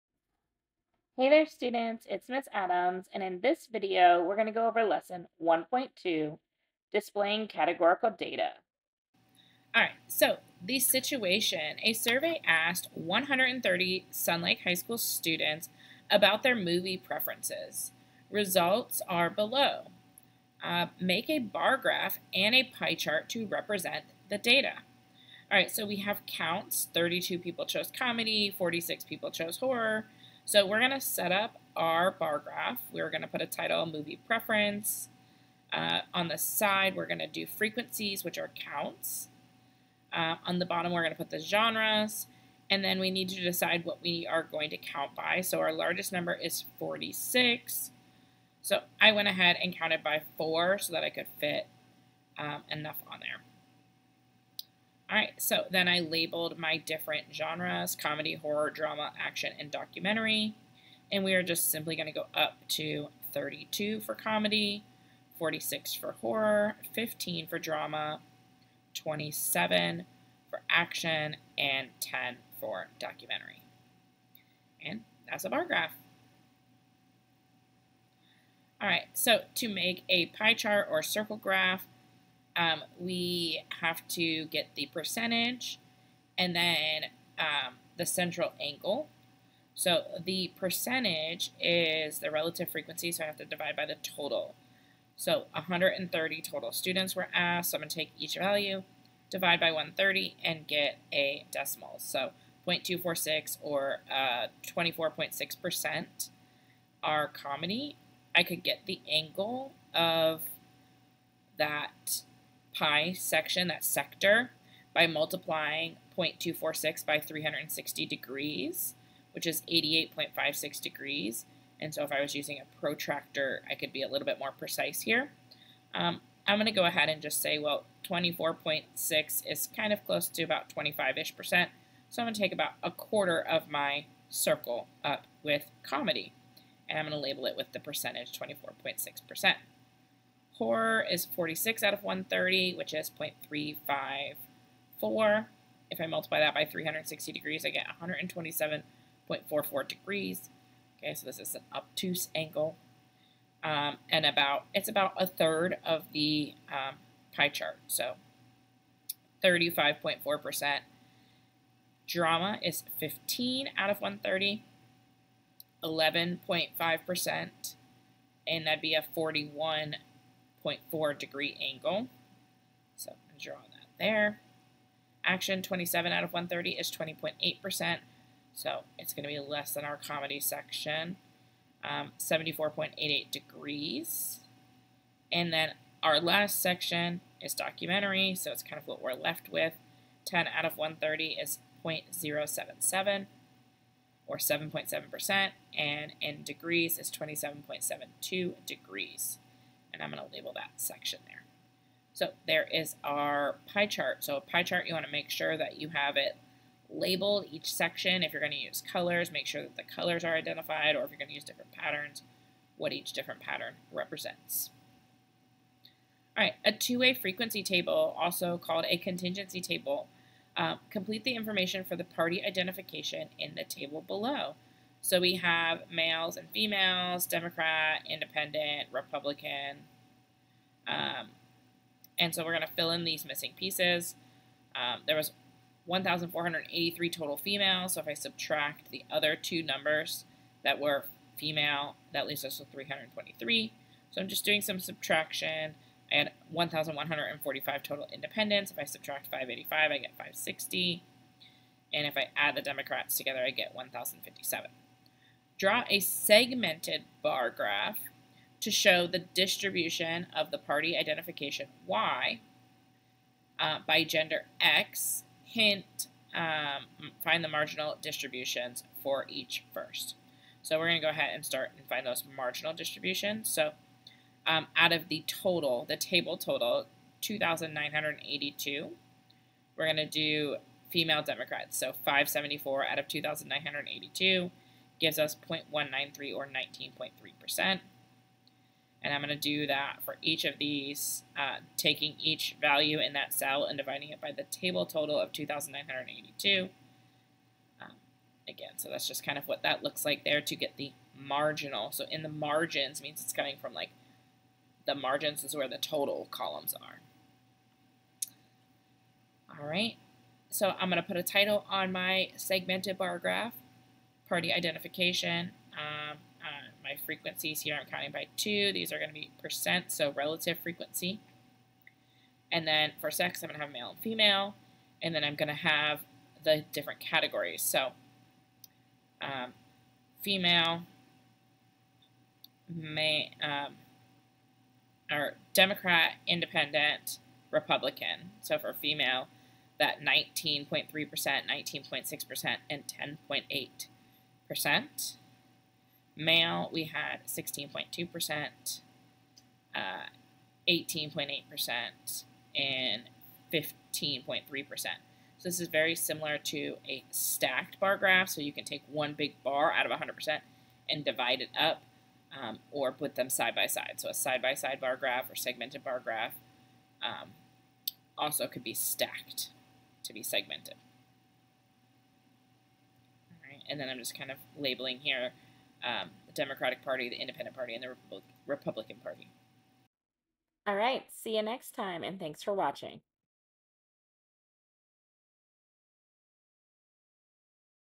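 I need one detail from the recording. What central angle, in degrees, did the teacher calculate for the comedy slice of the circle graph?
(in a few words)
88.56 degrees.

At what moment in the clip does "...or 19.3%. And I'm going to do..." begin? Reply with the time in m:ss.
4:46.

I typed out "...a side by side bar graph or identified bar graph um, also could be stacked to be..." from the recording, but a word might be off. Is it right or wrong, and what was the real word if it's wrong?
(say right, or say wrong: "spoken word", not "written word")
wrong: "segmented", not "identified".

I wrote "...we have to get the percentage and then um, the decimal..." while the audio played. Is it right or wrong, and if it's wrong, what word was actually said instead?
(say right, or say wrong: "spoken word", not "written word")
wrong: "central", not "decimal".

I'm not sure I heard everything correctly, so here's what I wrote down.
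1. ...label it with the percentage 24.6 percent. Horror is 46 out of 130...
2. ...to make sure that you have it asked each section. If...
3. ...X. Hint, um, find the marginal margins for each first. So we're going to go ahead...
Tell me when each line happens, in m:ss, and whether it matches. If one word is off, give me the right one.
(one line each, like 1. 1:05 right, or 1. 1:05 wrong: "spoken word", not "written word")
1. 2:17 right
2. 3:25 wrong: "labeled", not "asked"
3. 4:24 wrong: "distributions", not "margins".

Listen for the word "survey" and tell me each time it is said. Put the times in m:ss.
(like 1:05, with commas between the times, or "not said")
0:11.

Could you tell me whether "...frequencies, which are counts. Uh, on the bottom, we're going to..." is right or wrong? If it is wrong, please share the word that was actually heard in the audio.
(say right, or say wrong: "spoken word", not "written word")
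right.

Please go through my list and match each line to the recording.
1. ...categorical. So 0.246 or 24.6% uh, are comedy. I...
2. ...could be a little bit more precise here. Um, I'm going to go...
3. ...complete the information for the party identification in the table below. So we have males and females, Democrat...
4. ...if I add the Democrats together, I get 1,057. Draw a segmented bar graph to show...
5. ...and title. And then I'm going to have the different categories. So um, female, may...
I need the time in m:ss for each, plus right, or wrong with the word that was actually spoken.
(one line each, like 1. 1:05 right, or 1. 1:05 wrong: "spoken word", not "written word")
1. 1:41 wrong: "decimal", not "categorical"
2. 2:03 right
3. 3:40 right
4. 4:12 right
5. 5:23 wrong: "female", not "title".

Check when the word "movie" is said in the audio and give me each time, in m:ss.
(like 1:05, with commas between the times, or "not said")
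0:16, 0:33.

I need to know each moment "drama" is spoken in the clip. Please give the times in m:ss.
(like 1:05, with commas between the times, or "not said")
0:58, 1:07, 2:42.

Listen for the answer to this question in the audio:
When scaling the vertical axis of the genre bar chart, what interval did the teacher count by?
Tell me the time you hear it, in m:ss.
0:49.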